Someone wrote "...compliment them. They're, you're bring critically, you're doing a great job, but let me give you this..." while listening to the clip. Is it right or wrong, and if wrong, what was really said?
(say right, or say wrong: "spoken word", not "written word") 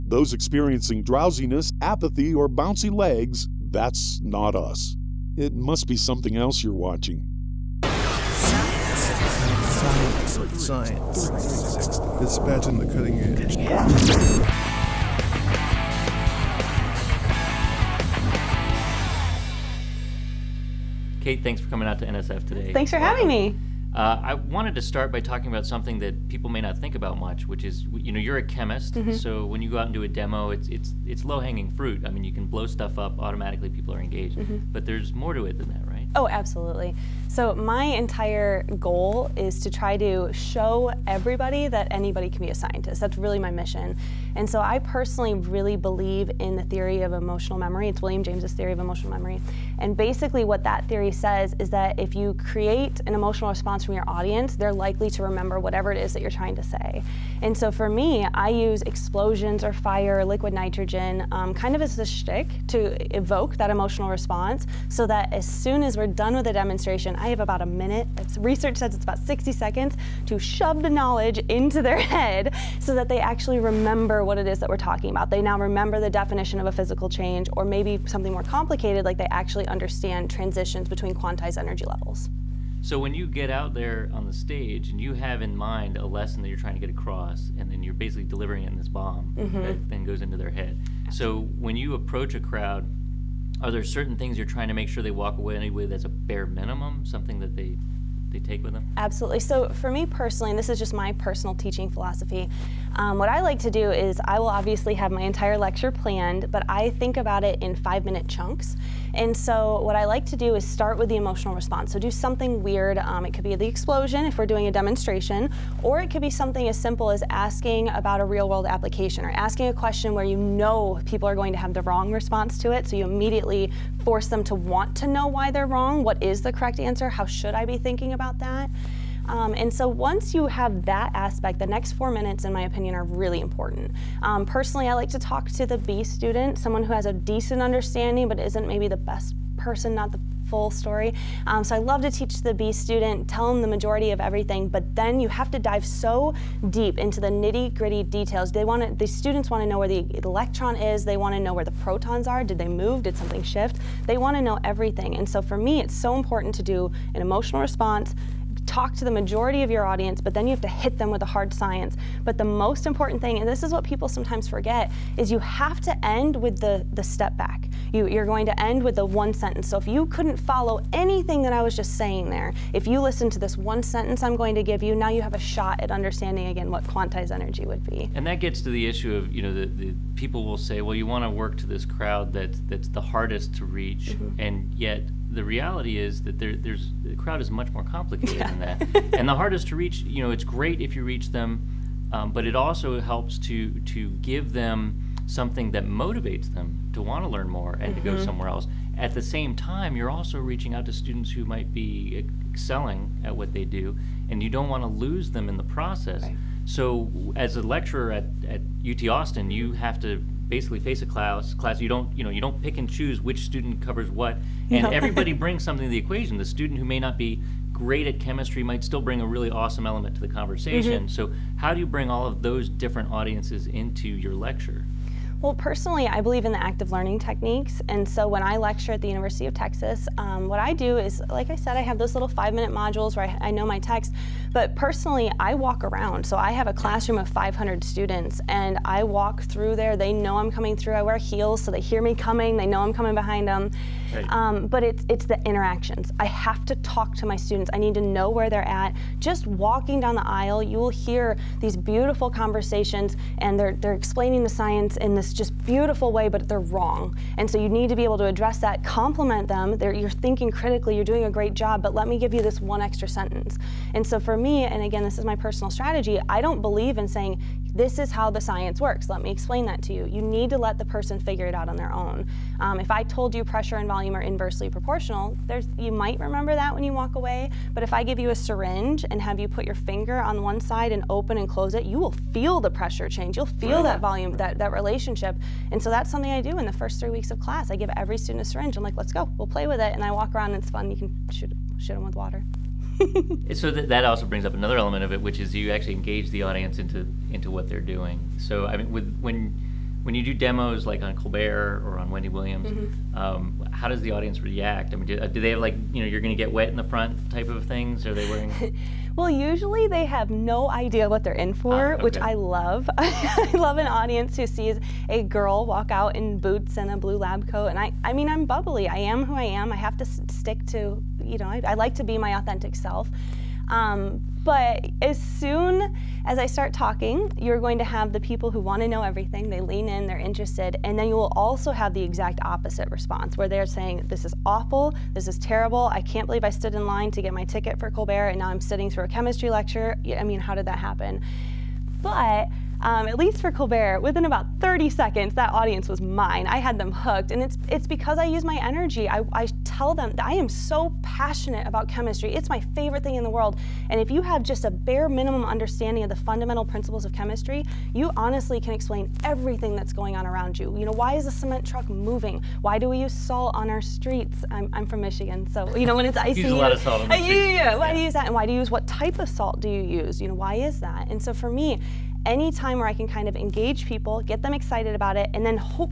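wrong: "thinking", not "bring".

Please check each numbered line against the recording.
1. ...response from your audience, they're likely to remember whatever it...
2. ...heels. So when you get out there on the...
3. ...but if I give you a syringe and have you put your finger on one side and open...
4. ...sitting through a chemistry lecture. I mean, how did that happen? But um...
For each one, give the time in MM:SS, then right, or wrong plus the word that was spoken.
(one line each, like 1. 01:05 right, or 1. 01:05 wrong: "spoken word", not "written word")
1. 00:53 right
2. 01:21 wrong: "levels", not "heels"
3. 04:37 right
4. 05:38 right.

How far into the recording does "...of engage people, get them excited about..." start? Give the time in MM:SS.
06:13.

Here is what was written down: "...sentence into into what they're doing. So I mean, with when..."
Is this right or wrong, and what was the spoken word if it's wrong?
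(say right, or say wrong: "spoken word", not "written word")
wrong: "audience", not "sentence".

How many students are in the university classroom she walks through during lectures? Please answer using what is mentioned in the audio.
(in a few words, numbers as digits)
500.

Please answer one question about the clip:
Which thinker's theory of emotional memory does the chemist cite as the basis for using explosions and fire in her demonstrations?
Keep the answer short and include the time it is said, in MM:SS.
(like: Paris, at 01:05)
William James, at 00:48.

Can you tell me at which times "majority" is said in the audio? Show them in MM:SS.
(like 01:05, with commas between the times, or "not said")
02:23, 02:39.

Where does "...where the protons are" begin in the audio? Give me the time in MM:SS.
02:31.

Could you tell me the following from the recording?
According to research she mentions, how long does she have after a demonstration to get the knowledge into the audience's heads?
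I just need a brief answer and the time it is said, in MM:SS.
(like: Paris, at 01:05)
60 seconds, at 01:09.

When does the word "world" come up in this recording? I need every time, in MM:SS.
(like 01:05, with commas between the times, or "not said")
01:58, 05:53.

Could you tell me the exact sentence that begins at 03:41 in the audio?
So, how do you bring all of those different audiences into your lecture?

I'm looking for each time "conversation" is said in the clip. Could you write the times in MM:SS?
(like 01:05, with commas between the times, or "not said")
03:40, 04:12.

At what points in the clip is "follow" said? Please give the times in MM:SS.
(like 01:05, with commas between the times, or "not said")
02:50.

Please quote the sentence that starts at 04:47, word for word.
I give every student a syringe.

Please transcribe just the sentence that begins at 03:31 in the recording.
Class you don't you know you don't pick and choose which student covers what and everybody brings something to the equation.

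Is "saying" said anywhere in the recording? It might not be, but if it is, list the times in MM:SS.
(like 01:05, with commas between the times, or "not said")
02:51, 04:27, 05:33.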